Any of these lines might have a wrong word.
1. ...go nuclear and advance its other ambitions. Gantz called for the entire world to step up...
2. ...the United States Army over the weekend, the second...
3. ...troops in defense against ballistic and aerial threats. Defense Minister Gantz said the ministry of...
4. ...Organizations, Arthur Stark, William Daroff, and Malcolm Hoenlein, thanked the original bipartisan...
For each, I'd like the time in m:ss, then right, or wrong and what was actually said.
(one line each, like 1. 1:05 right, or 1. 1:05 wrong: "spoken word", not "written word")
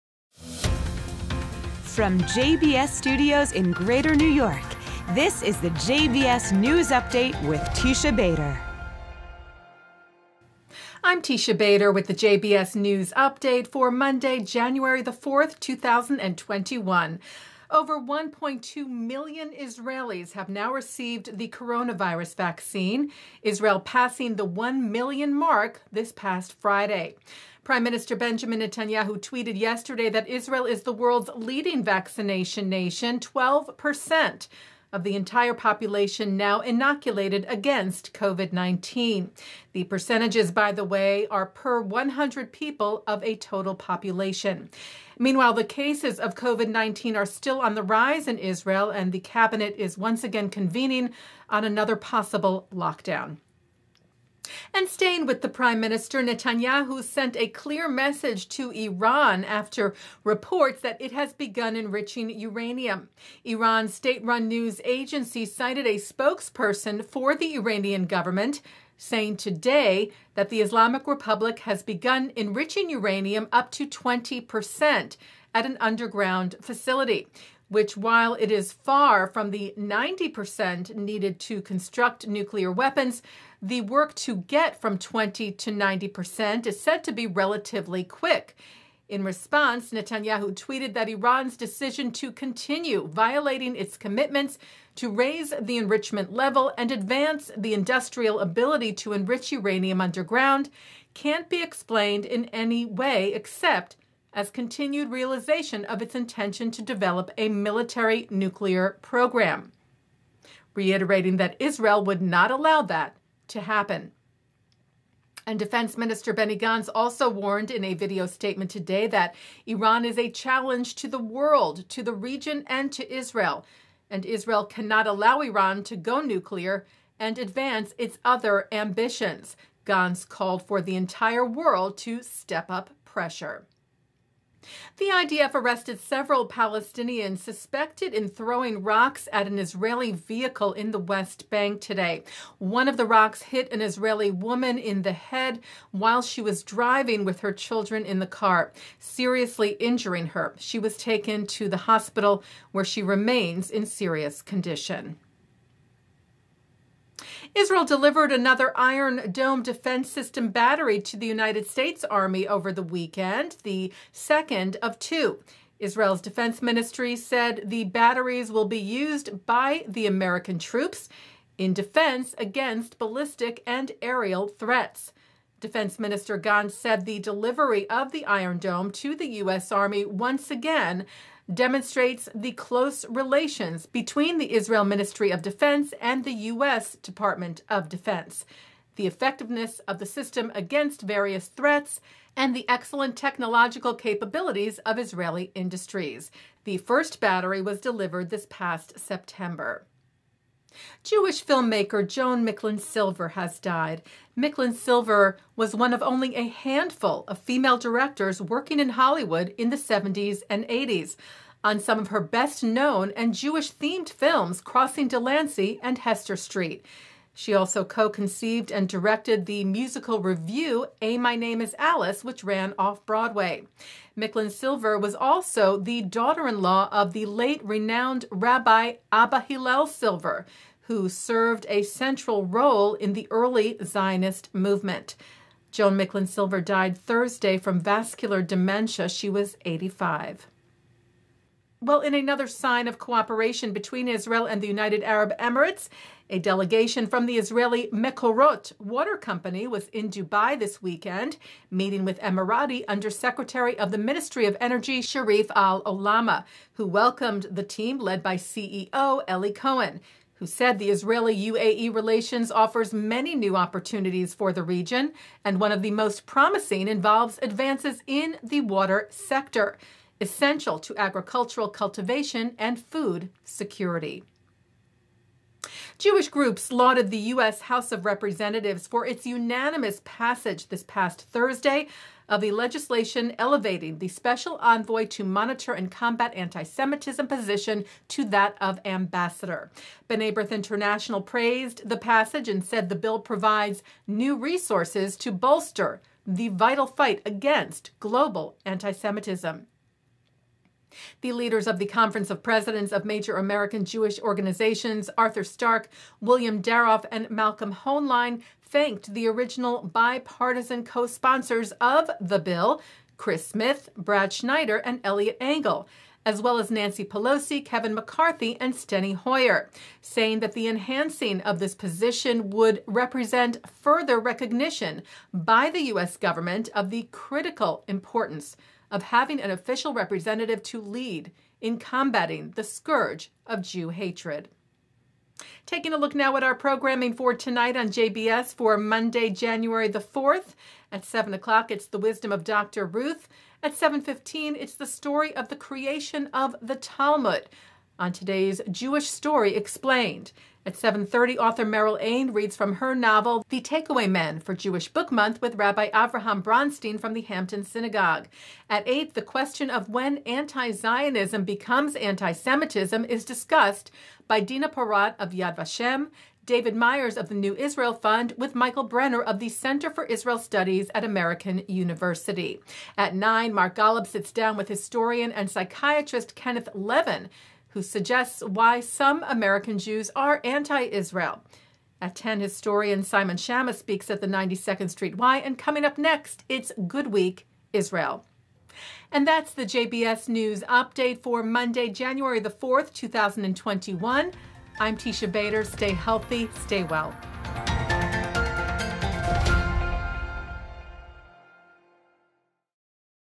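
1. 2:05 right
2. 2:41 right
3. 2:50 wrong: "delivery", not "ministry"
4. 5:04 right.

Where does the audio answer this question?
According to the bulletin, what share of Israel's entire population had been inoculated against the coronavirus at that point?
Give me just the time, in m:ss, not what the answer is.
0:33.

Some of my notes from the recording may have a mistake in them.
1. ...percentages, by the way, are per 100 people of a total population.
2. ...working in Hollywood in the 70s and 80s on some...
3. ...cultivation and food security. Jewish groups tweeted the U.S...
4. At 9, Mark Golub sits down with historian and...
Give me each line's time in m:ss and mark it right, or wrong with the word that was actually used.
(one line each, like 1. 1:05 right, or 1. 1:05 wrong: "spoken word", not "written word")
1. 0:39 right
2. 3:28 right
3. 4:31 wrong: "lauded", not "tweeted"
4. 6:12 right.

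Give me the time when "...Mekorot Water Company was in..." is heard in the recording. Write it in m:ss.
4:07.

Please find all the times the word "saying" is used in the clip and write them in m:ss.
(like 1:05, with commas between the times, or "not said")
1:08, 5:20.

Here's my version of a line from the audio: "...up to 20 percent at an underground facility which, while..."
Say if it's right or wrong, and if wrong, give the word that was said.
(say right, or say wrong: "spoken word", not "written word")
right.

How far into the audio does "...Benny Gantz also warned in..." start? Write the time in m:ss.
1:56.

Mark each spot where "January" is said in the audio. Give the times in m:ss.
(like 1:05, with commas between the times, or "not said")
0:14, 5:39, 6:31.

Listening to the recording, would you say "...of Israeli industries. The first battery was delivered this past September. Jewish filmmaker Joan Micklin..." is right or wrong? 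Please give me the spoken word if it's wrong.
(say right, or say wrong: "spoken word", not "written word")
right.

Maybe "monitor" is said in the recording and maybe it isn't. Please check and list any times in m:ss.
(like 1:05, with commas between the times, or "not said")
4:45.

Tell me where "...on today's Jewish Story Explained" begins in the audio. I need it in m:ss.
5:47.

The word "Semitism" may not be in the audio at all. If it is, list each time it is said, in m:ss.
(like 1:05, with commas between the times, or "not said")
4:46, 4:58, 6:01.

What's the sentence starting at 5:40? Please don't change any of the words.
At 7 o'clock, it's The Wisdom of Dr.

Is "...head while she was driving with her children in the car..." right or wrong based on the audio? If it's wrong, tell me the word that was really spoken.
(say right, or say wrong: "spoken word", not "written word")
right.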